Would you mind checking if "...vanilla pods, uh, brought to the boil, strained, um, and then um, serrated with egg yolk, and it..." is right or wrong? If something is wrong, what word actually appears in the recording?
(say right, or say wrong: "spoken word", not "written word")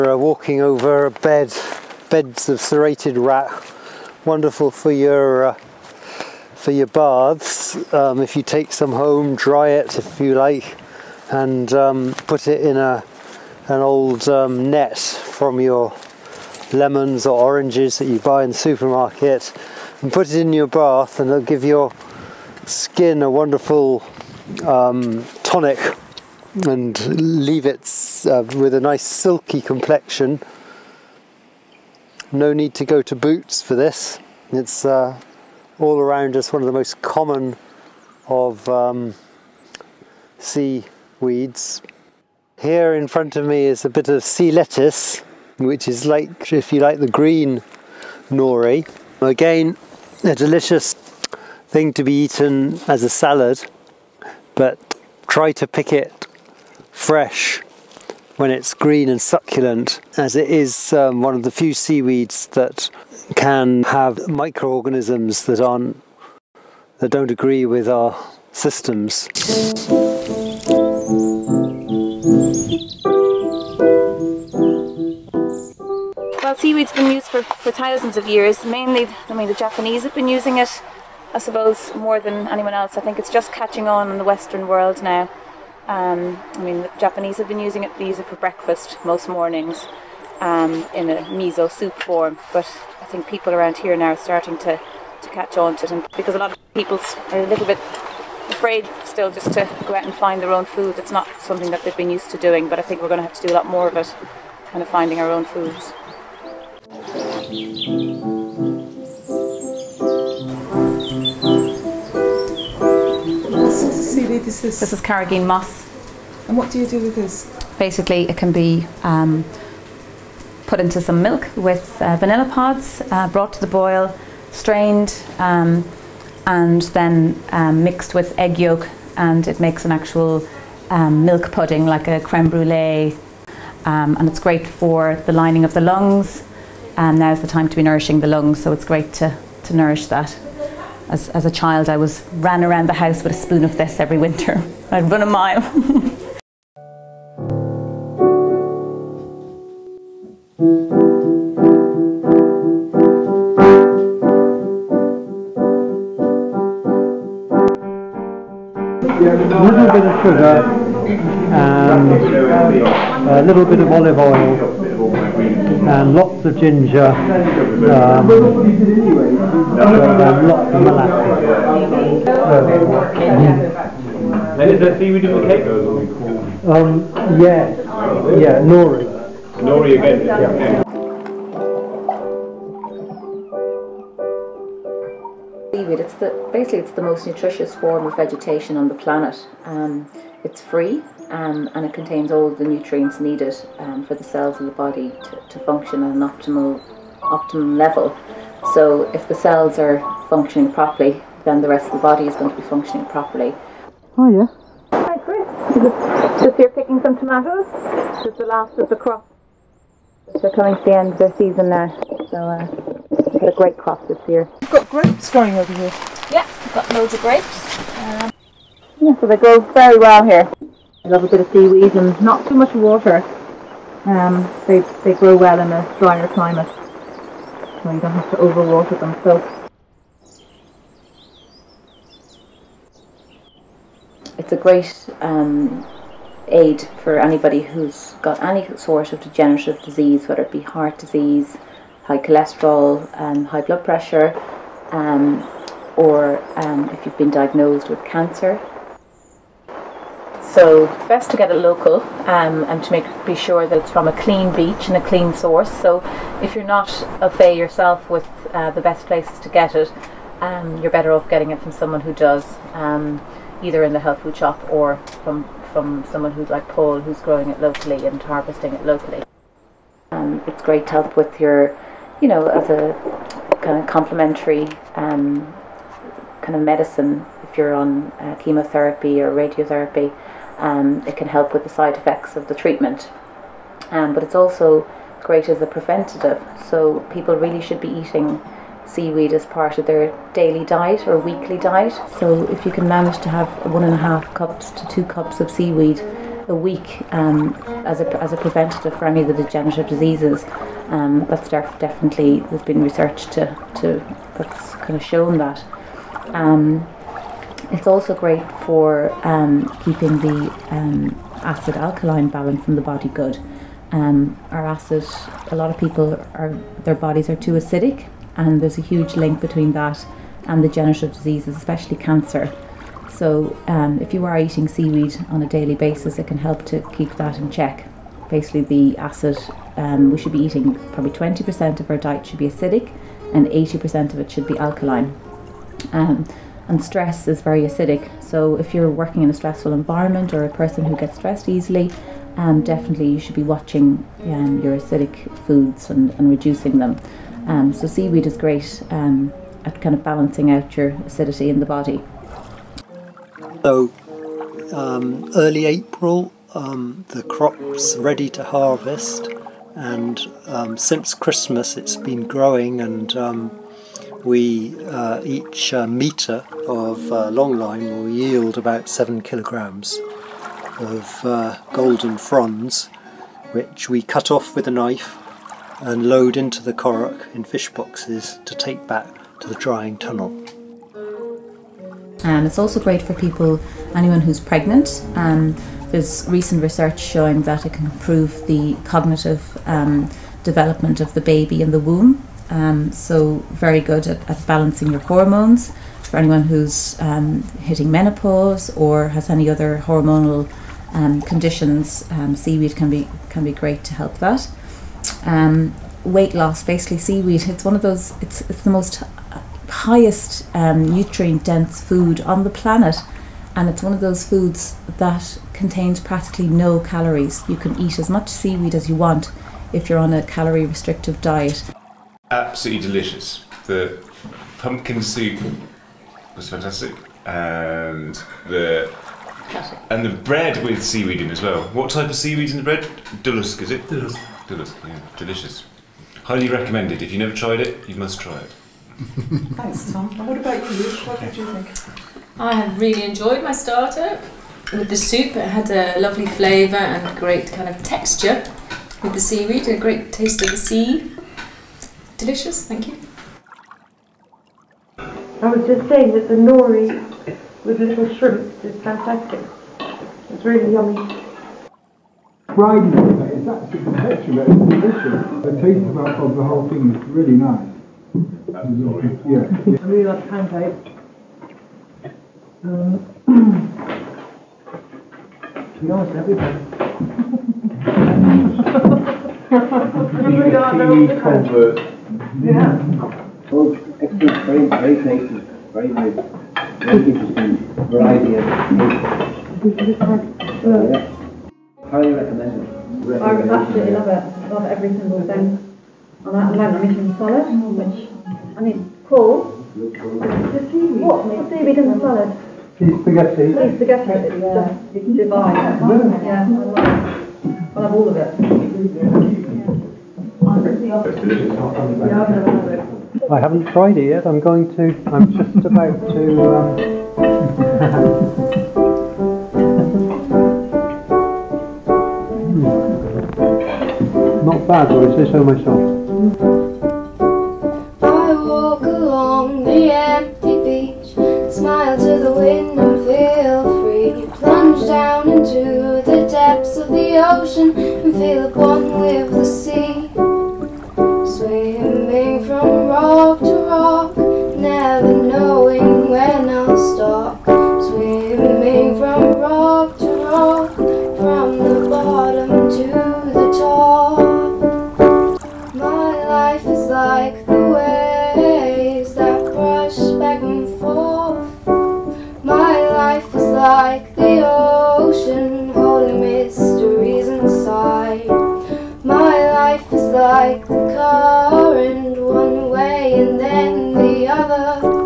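wrong: "mixed", not "serrated".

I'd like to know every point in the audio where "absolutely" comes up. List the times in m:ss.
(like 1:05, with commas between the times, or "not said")
7:02, 7:48, 8:13.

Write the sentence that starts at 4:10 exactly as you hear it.
So best to get it local um, and to make be sure that it's from a clean beach and a clean source.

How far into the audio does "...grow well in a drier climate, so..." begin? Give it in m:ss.
3:45.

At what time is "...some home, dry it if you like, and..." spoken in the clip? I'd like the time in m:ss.
0:08.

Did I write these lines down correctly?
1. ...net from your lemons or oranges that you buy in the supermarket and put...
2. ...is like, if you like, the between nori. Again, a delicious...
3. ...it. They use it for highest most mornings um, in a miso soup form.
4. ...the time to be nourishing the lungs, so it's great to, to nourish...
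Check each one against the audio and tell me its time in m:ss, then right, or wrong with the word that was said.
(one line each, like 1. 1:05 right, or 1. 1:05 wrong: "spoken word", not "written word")
1. 0:14 right
2. 0:45 wrong: "green", not "between"
3. 1:27 wrong: "breakfast", not "highest"
4. 2:17 right.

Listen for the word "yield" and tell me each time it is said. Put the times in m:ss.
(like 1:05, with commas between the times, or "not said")
6:08.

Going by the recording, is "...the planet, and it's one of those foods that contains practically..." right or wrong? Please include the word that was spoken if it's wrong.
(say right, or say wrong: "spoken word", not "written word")
right.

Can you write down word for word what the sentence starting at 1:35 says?
And because a lot of people are a little bit afraid still just to go out and find their own food.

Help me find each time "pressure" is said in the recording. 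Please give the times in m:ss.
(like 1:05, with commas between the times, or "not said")
4:03.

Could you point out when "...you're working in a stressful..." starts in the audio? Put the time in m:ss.
5:38.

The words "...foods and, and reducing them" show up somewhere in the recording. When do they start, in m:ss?
5:45.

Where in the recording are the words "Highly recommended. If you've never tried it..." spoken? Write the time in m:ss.
7:16.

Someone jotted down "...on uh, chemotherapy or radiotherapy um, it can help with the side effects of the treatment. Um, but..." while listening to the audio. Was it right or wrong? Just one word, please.
right.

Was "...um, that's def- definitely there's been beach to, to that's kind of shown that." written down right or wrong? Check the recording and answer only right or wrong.
wrong.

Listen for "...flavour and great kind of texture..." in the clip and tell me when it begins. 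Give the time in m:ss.
7:26.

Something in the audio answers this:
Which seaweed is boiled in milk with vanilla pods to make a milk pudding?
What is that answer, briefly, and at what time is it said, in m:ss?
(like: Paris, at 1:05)
Carrageen moss, at 1:55.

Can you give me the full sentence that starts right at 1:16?
Well, seaweed's been used for, for thousands of years.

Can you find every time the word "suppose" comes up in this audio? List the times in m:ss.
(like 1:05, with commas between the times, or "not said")
1:21.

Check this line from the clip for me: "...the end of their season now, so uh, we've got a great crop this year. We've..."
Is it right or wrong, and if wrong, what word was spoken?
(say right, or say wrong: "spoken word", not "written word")
right.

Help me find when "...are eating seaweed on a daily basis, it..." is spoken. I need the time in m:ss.
5:24.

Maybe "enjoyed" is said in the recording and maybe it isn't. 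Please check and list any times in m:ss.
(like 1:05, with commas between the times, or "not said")
7:23.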